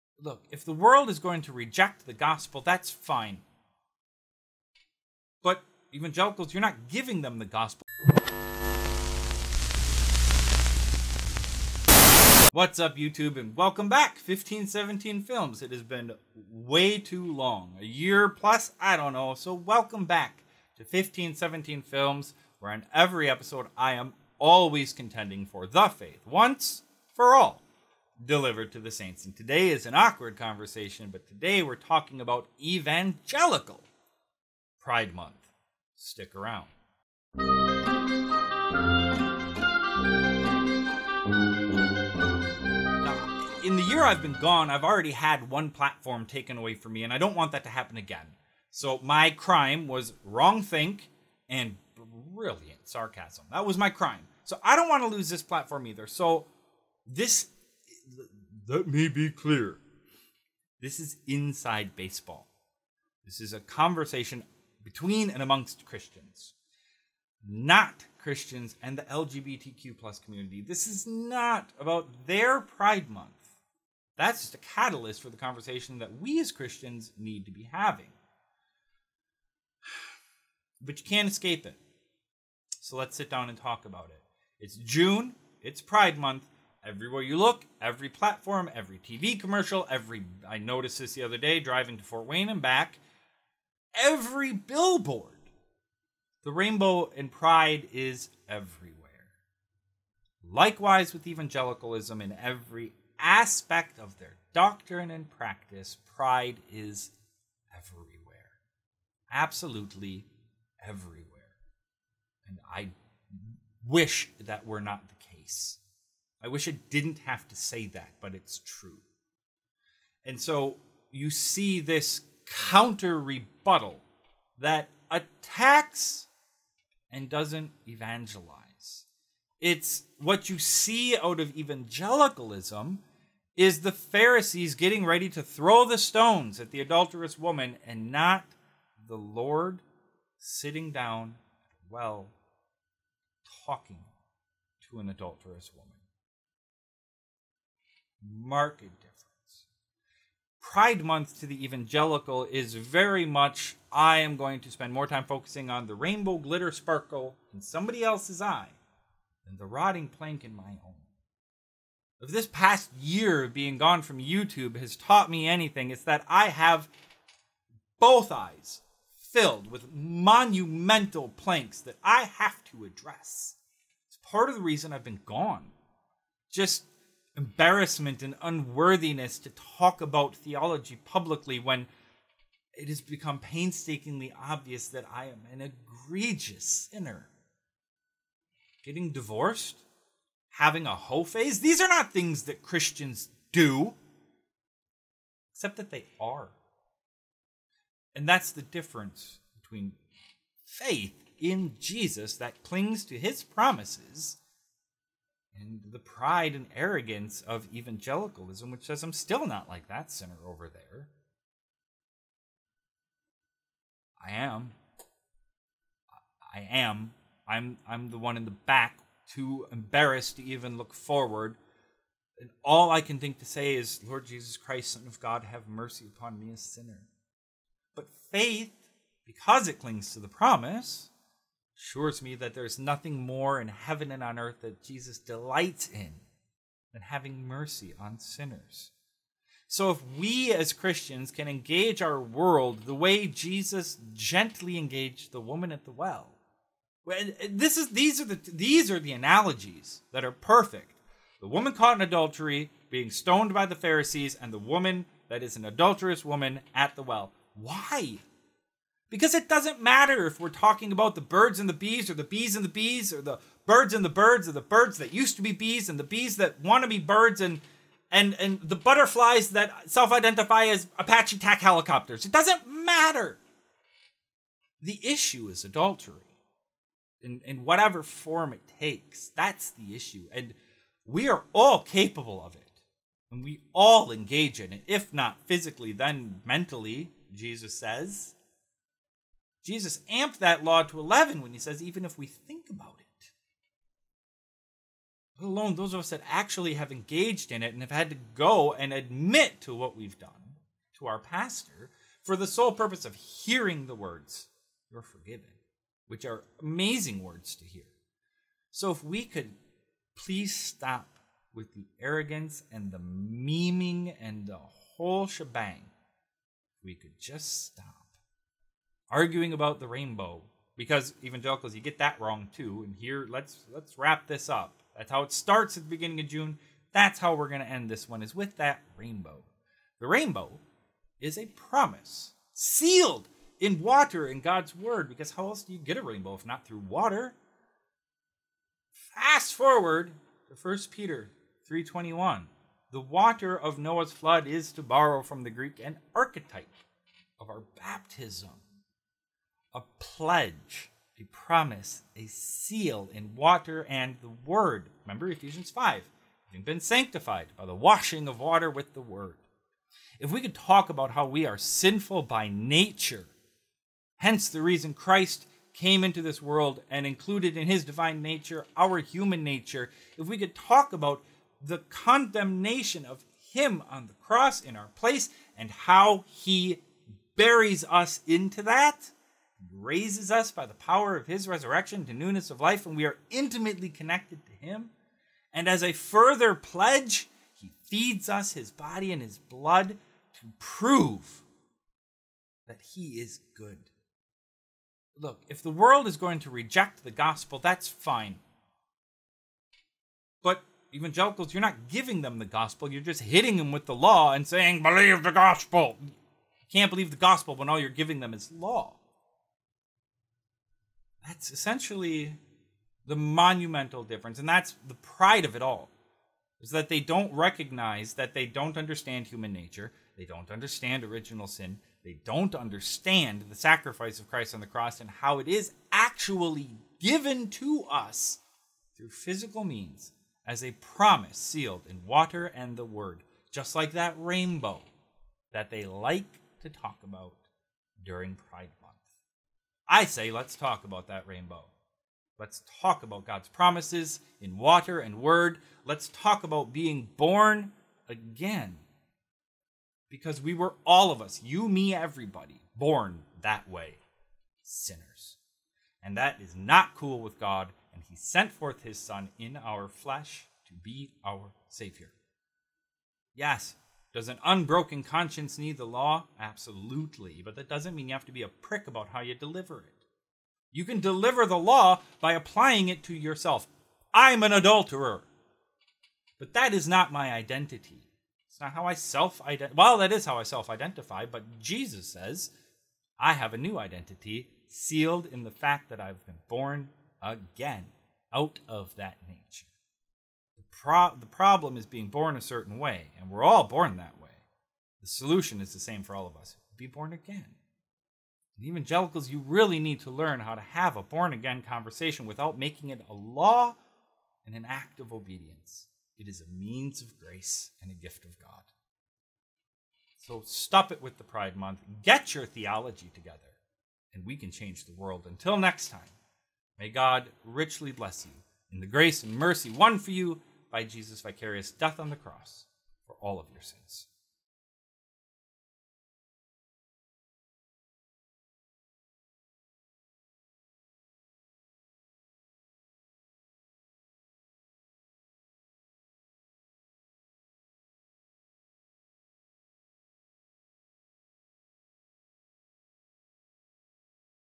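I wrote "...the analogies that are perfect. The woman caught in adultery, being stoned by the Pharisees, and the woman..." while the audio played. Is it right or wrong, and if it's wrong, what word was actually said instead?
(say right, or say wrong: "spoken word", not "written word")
right.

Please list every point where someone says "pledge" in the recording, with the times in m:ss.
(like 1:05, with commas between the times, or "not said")
5:49, 6:26.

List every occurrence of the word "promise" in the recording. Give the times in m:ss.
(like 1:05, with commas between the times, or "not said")
3:23, 3:50, 5:31, 5:51, 7:10, 7:23.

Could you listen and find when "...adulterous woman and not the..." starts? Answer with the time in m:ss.
2:16.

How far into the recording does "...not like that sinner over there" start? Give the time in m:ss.
3:29.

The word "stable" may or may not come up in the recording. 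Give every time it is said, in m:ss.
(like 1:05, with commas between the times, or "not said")
not said.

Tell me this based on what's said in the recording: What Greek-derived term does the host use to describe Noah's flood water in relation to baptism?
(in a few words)
archetype.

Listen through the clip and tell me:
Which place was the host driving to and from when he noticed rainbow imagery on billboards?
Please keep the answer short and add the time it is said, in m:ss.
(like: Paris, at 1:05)
Fort Wayne, at 1:32.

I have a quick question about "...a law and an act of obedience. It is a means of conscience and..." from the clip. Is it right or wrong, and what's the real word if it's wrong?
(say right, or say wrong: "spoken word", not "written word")
wrong: "grace", not "conscience".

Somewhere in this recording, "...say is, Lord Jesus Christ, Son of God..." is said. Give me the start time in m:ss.
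3:43.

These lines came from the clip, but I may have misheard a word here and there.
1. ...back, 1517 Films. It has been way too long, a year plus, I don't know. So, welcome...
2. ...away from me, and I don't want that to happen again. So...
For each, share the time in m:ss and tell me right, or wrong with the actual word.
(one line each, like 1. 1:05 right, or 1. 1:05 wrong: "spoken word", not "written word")
1. 0:13 right
2. 0:46 right.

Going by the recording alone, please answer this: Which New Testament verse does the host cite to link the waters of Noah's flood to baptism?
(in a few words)
1 Peter 3:21.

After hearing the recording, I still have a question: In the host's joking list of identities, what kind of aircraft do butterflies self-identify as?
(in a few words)
Apache attack helicopters.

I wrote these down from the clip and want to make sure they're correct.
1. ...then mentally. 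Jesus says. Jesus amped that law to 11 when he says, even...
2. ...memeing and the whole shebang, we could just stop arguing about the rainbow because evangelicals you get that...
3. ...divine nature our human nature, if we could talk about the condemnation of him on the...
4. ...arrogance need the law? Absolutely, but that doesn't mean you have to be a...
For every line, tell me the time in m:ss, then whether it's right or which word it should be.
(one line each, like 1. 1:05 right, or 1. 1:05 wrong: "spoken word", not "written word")
1. 4:45 right
2. 5:12 right
3. 6:07 right
4. 7:45 wrong: "conscience", not "arrogance".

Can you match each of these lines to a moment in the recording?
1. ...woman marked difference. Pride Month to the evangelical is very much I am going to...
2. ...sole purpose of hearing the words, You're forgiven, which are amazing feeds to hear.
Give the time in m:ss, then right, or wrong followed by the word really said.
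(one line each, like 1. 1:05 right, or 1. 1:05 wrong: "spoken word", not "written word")
1. 2:25 right
2. 5:02 wrong: "words", not "feeds".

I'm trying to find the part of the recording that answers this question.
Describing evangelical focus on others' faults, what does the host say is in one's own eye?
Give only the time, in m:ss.
2:39.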